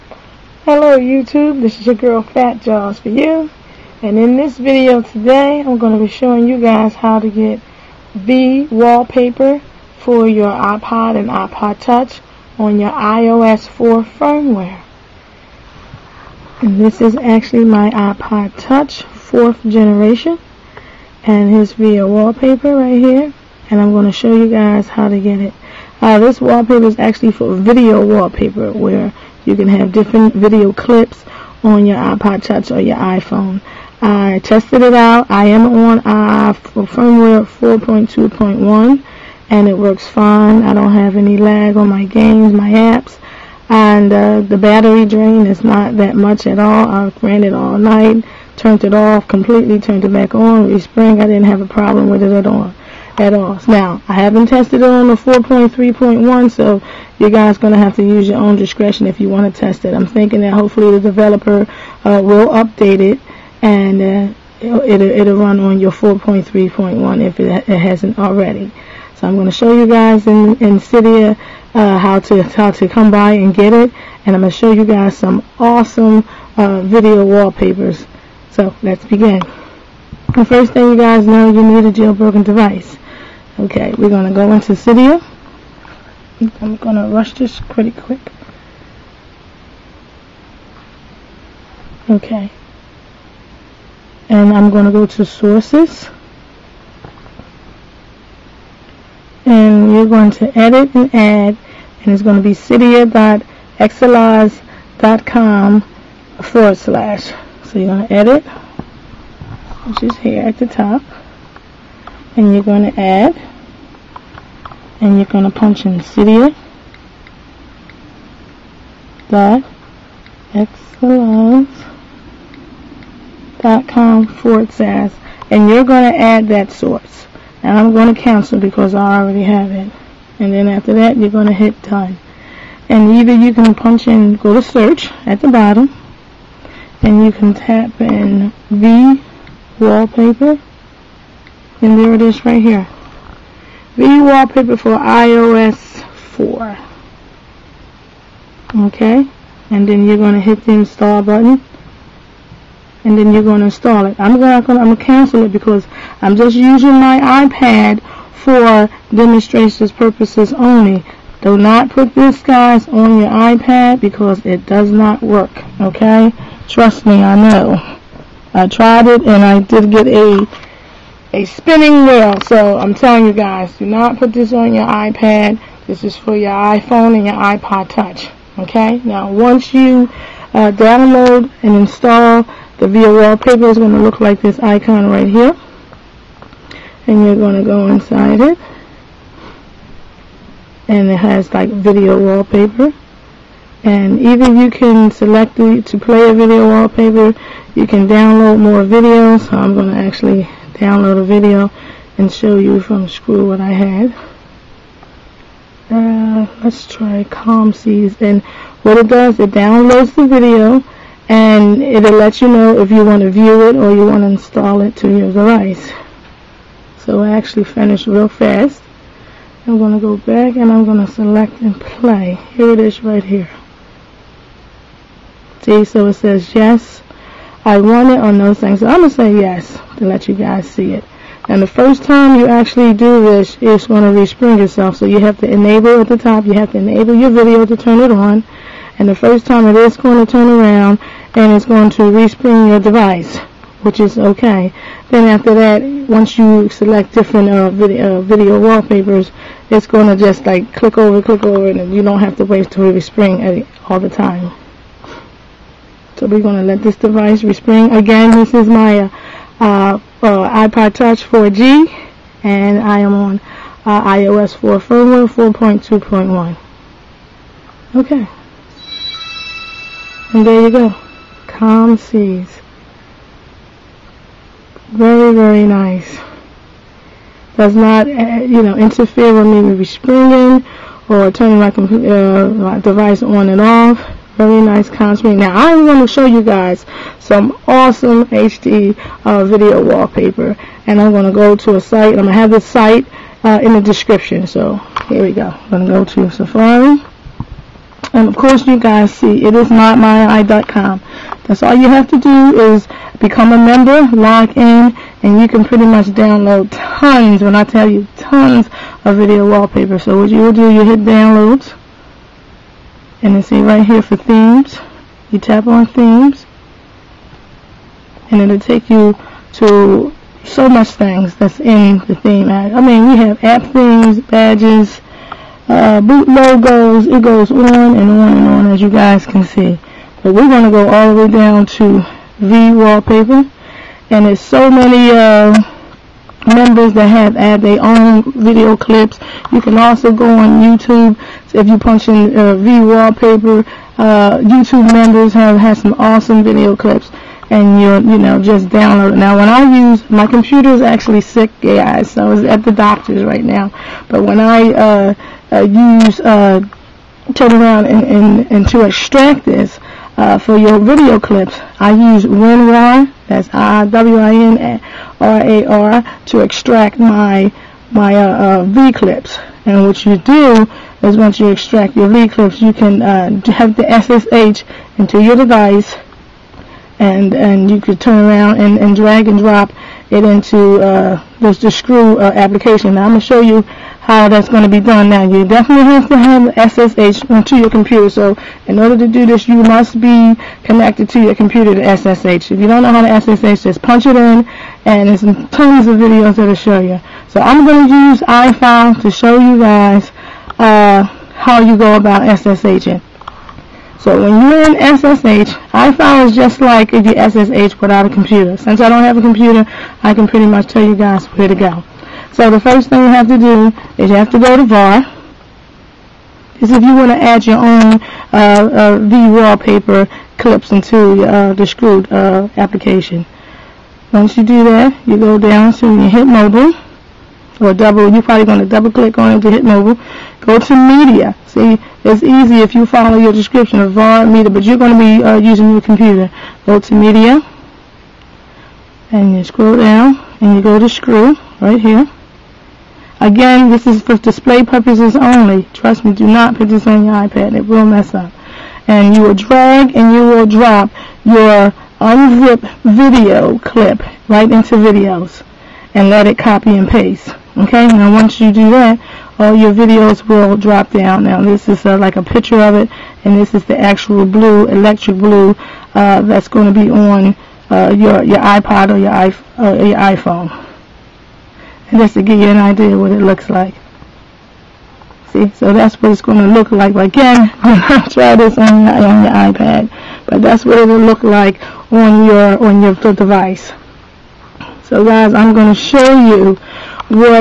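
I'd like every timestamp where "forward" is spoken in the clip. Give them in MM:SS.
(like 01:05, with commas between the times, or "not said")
01:46, 02:04.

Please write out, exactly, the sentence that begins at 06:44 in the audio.
So when you're in SSH, I found it's just like if you SSH without a computer.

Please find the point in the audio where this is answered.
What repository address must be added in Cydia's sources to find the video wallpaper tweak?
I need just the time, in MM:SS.
01:42.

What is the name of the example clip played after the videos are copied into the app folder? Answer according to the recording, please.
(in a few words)
electric blue.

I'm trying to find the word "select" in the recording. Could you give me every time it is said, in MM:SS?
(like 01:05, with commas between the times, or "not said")
03:15, 03:41, 04:06.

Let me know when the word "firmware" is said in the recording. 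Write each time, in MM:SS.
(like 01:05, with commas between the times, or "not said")
00:14, 00:36, 04:24.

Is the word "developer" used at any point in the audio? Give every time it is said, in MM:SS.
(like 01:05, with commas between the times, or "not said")
01:01.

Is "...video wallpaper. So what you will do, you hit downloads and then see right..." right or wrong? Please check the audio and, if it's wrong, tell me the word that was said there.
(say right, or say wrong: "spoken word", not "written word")
right.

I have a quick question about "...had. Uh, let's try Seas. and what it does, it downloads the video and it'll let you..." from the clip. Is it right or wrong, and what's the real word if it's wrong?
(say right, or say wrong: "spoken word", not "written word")
right.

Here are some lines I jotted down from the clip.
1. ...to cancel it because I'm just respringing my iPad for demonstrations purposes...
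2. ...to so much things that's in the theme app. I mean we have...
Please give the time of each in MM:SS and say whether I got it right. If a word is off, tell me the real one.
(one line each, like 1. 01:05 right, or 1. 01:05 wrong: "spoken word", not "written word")
1. 02:34 wrong: "using", not "respringing"
2. 05:19 right.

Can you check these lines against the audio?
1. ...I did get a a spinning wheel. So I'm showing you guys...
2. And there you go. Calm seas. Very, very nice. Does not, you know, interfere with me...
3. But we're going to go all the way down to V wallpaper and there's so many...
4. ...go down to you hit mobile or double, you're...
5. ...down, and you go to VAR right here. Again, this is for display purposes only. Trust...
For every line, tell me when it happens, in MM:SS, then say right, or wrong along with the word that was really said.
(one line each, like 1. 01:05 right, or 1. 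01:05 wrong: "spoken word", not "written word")
1. 02:49 wrong: "telling", not "showing"
2. 04:30 right
3. 05:30 right
4. 07:05 right
5. 07:19 wrong: "Skrew", not "VAR".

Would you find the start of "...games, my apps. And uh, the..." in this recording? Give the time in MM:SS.
00:42.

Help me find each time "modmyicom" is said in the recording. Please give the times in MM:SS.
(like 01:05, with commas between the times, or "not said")
04:59.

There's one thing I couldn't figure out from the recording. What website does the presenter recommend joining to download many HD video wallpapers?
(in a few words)
modmyi.com.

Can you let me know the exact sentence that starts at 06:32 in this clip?
If you don't know how to SSH, just punch it in, and there's tons of videos that'll show you.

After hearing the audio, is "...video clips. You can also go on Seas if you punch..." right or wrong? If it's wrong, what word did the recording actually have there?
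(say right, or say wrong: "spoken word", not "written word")
wrong: "YouTube", not "Seas".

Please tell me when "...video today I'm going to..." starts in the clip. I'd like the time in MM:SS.
00:04.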